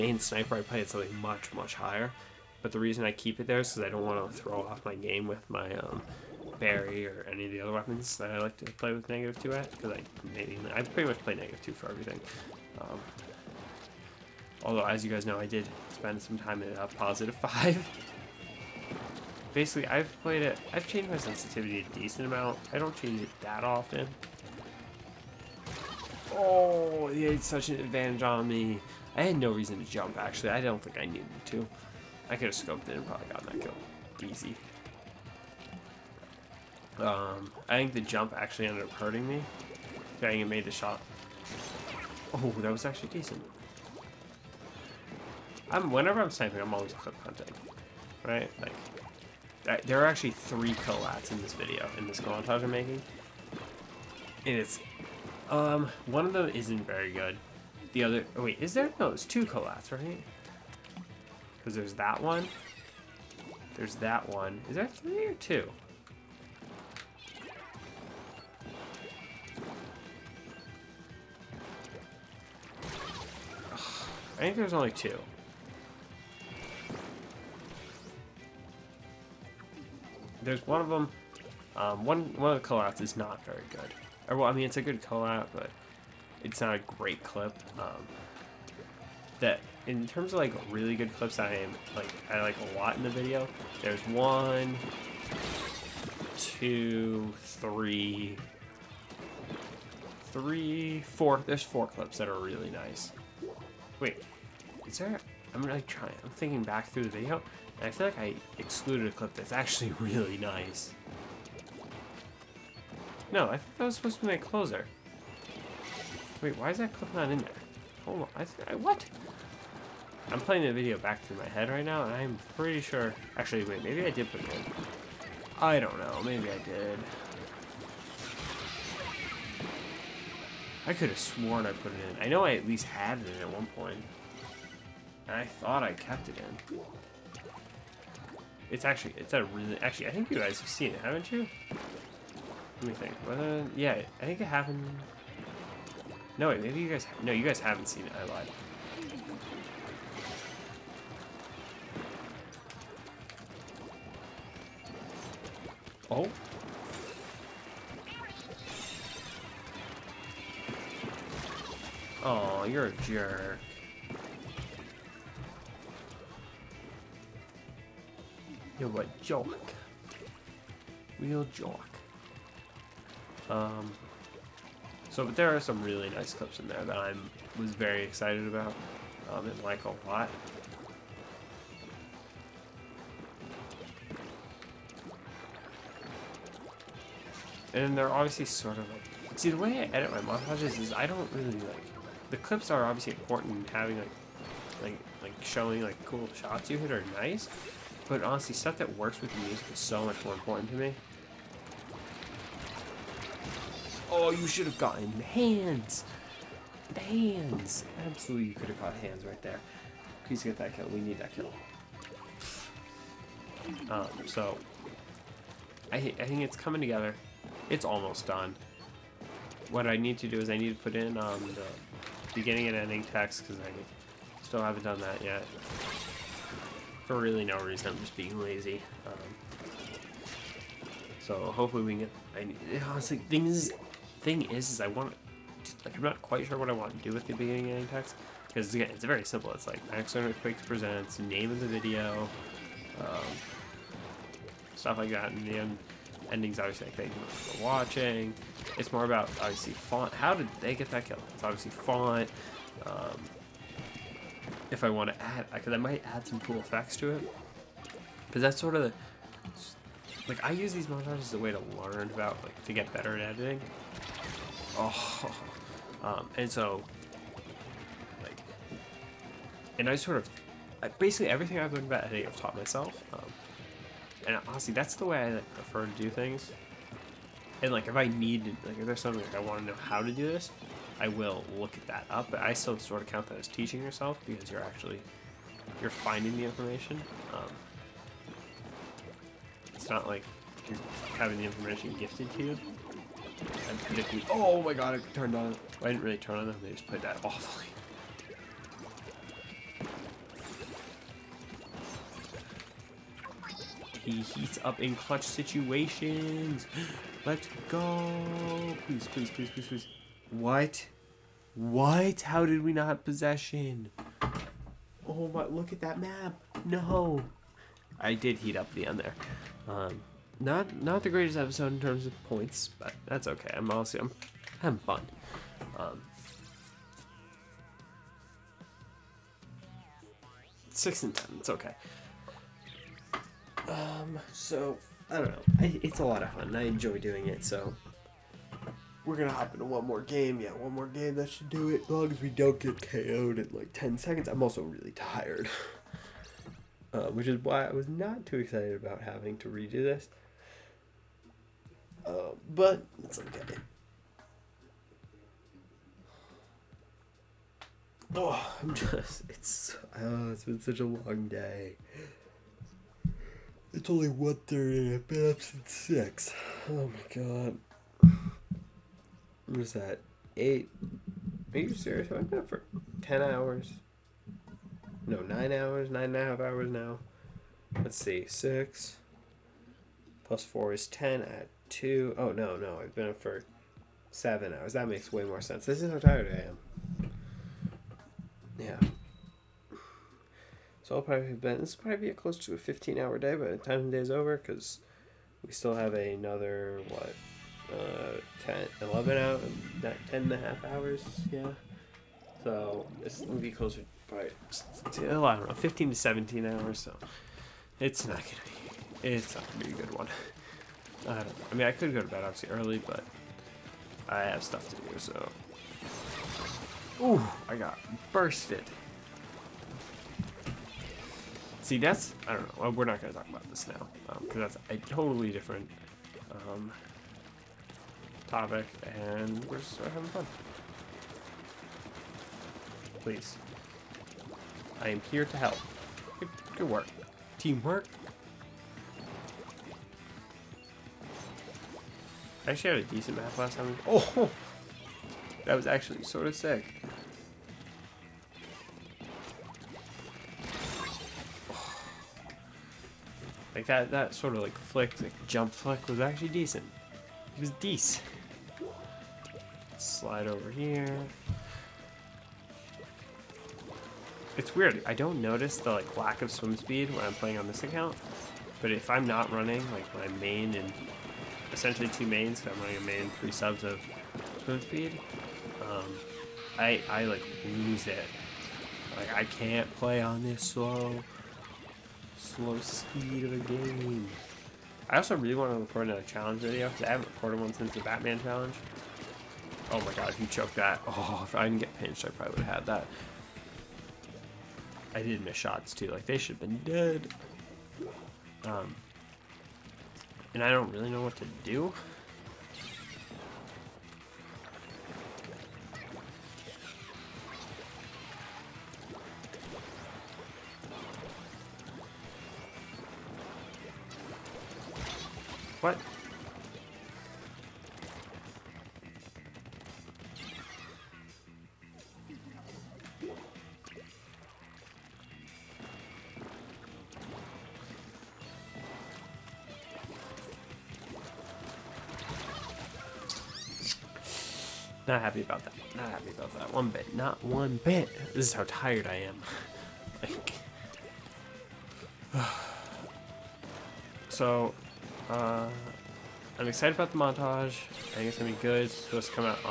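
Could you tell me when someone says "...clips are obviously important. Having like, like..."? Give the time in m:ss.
3:12.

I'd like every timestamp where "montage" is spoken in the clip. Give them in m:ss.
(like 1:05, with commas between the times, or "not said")
0:52, 3:10, 4:20, 9:06.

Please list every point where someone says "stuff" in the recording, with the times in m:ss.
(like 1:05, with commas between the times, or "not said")
3:18, 4:04, 6:54.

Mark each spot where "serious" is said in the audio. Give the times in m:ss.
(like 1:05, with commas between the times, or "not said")
6:11.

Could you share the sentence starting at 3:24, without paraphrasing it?
Oh, you should have gotten hands, hands.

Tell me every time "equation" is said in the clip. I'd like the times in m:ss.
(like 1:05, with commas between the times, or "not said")
not said.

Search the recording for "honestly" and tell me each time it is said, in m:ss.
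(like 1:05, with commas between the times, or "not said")
3:18, 3:52, 4:34.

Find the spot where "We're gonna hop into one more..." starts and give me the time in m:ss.
5:39.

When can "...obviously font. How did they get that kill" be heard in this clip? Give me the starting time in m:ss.
4:09.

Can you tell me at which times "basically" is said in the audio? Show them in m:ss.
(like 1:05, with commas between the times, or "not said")
0:19, 4:30.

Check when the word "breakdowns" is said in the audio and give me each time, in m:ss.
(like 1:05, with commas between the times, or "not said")
not said.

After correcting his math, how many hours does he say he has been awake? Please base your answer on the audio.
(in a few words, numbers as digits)
7 hours.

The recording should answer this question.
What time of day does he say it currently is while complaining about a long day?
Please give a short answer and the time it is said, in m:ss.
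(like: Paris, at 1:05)
1:30, at 6:04.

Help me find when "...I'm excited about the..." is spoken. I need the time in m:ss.
9:06.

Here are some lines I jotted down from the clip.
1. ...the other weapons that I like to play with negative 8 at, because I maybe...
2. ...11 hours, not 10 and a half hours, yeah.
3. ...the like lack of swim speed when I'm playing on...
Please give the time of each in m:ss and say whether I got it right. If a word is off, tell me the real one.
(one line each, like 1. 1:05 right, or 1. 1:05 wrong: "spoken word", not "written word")
1. 0:07 wrong: "2", not "8"
2. 6:38 right
3. 7:45 right.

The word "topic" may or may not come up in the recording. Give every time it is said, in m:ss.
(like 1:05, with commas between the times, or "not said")
7:08.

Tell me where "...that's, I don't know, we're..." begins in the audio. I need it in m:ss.
7:01.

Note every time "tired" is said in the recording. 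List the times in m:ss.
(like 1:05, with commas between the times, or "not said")
5:44, 6:25, 8:58.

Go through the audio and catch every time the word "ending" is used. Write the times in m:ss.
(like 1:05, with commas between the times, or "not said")
3:42, 3:57, 4:06.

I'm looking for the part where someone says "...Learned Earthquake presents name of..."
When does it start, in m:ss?
4:00.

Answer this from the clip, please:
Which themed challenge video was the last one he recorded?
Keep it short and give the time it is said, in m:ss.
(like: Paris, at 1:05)
Batman challenge, at 8:07.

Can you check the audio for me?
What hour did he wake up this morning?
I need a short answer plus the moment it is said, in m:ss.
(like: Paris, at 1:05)
6, at 6:05.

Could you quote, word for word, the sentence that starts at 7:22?
I actually had a decent map last time.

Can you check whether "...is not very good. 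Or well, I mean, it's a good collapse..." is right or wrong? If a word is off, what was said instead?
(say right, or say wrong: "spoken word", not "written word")
right.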